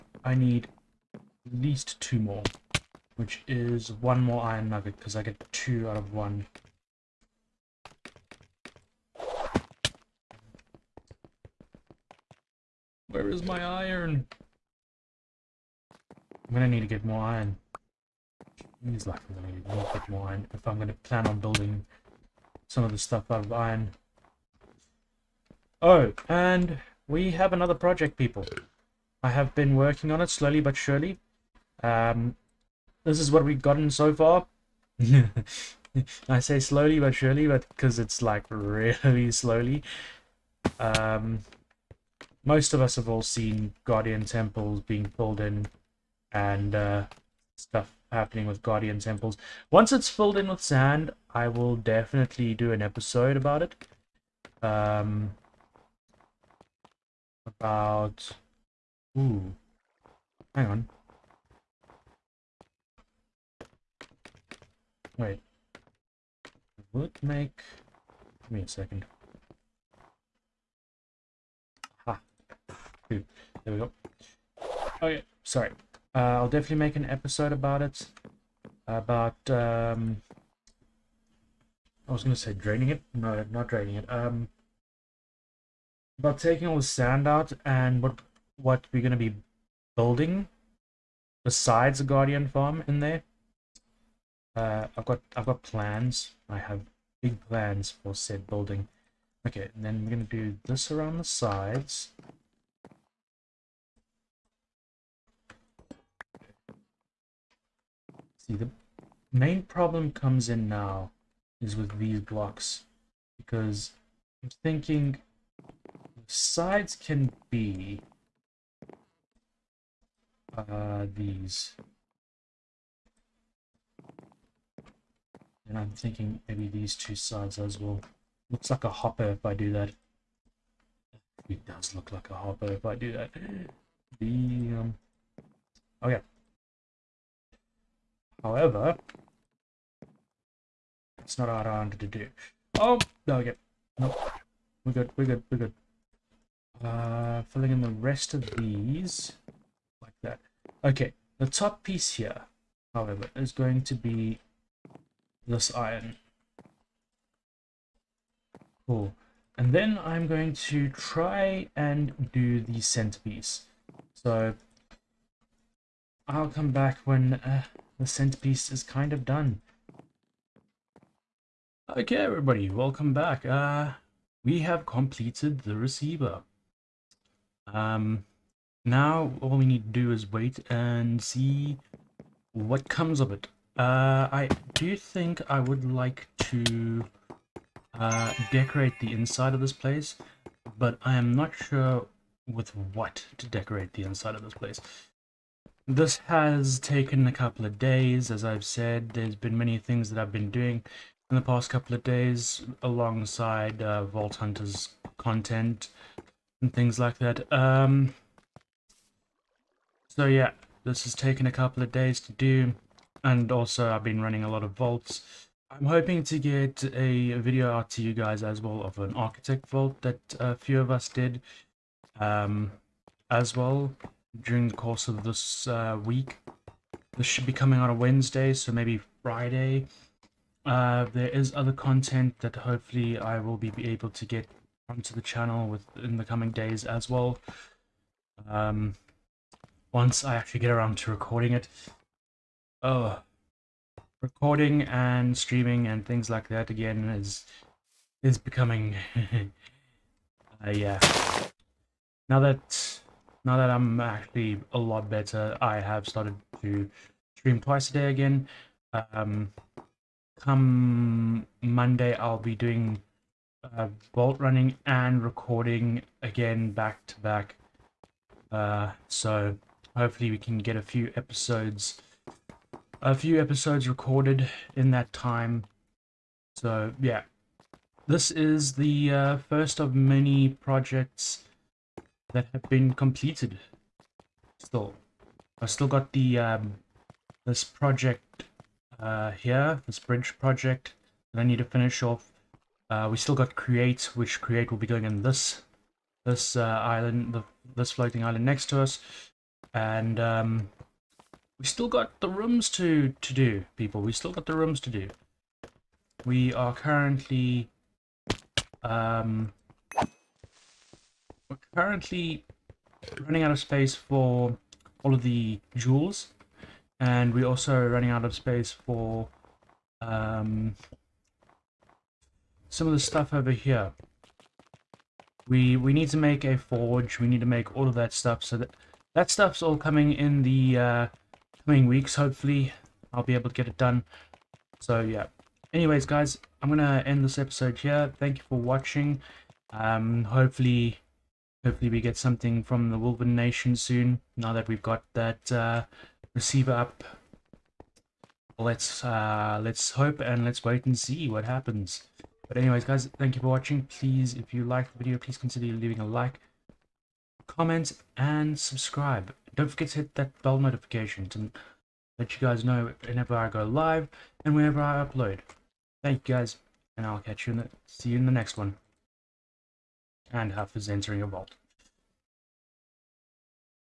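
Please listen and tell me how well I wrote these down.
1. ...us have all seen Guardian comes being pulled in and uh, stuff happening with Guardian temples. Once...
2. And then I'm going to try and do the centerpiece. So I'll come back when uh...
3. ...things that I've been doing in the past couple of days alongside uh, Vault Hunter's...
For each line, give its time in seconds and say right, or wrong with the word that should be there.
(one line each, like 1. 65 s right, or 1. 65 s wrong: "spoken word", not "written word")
1. 42 s wrong: "temples", not "comes"
2. 159 s right
3. 199 s right.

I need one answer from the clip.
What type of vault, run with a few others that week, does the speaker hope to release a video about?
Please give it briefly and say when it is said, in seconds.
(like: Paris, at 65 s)
Architect vault, at 219 s.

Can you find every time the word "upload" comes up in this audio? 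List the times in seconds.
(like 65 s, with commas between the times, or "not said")
365 s.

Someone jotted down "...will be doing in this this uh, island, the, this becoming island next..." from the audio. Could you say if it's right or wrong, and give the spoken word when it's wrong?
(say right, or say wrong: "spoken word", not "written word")
wrong: "floating", not "becoming".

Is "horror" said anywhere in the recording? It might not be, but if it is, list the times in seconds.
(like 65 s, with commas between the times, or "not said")
not said.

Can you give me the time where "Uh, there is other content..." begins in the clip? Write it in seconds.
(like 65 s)
230 s.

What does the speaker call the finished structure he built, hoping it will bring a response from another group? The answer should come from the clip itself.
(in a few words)
The receiver.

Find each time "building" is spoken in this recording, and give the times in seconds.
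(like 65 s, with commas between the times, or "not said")
21 s, 89 s, 98 s.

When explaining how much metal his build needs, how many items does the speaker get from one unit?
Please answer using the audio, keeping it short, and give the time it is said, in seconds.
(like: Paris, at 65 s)
2, at 5 s.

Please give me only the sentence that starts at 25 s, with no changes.
Oh, and we have another project, people.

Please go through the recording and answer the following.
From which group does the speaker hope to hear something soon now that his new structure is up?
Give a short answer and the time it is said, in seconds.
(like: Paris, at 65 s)
The Wolven Nation, at 342 s.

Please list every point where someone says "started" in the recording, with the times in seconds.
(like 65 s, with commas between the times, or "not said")
256 s.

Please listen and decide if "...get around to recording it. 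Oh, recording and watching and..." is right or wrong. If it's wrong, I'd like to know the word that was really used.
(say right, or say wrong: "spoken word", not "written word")
wrong: "streaming", not "watching".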